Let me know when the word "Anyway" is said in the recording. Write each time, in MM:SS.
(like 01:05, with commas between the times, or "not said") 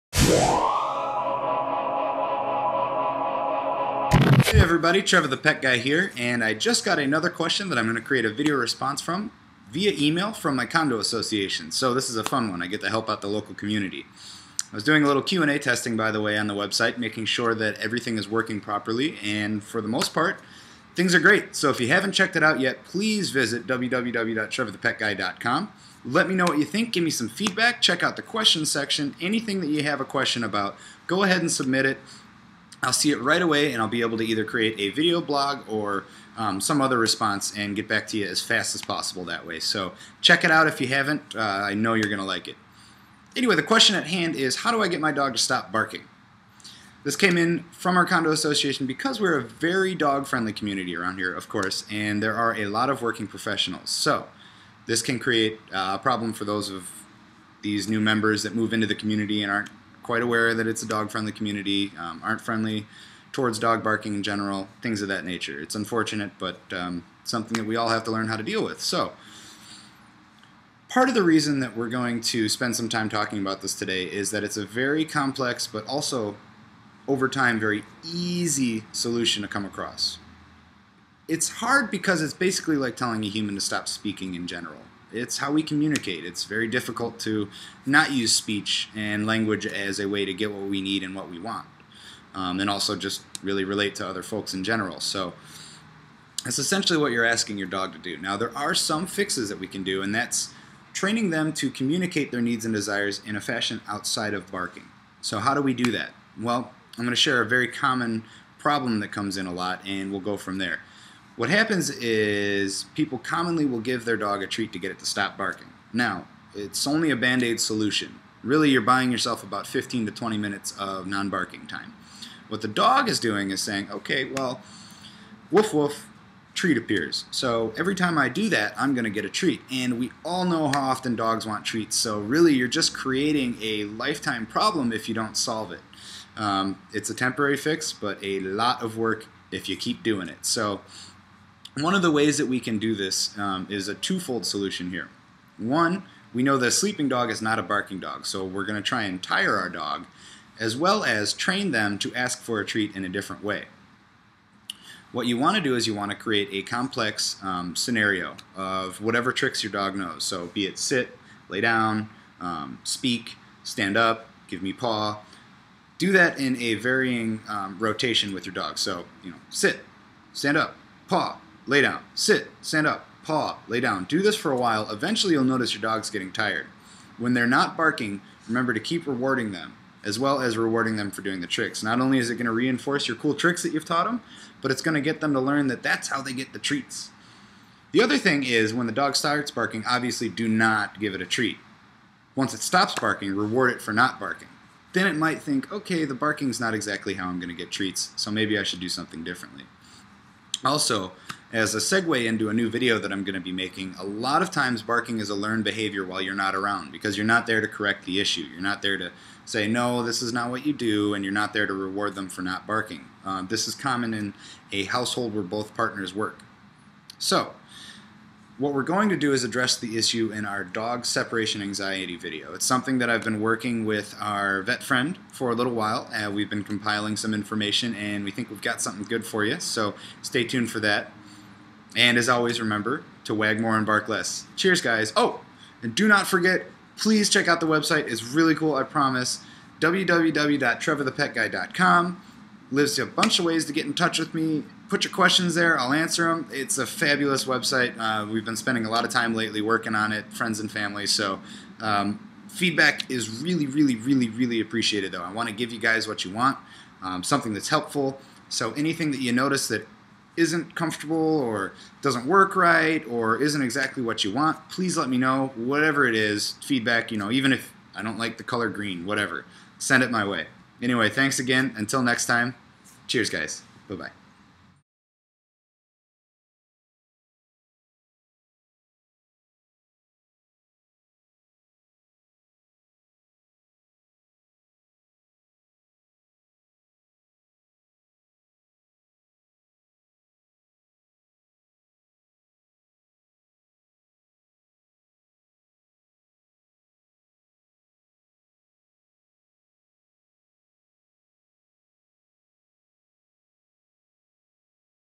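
00:43, 04:30.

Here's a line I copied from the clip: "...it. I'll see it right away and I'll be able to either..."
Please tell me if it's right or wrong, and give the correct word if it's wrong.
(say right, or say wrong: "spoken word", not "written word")
right.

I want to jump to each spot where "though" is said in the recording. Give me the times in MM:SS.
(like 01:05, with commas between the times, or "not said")
04:15.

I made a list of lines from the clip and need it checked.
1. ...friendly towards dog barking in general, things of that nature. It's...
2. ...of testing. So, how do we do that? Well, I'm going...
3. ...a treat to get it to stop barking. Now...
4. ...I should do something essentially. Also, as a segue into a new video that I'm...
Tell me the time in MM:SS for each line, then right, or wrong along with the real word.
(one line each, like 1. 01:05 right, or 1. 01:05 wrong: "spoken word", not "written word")
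1. 01:02 right
2. 01:44 wrong: "barking", not "testing"
3. 01:54 right
4. 03:18 wrong: "differently", not "essentially".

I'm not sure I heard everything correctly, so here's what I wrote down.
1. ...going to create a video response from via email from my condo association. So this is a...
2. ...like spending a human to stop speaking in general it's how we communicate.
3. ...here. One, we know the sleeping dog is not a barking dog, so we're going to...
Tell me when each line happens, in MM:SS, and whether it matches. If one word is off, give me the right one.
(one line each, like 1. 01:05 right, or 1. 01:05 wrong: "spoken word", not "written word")
1. 00:07 right
2. 01:22 wrong: "telling", not "spending"
3. 02:24 right.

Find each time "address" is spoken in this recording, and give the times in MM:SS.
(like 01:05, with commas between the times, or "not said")
03:39.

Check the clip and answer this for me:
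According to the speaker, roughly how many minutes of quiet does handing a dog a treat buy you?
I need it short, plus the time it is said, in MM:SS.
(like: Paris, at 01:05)
15 to 20 minutes, at 01:59.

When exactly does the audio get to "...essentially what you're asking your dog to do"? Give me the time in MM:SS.
01:36.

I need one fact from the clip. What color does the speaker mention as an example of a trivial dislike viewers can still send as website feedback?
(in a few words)
Green.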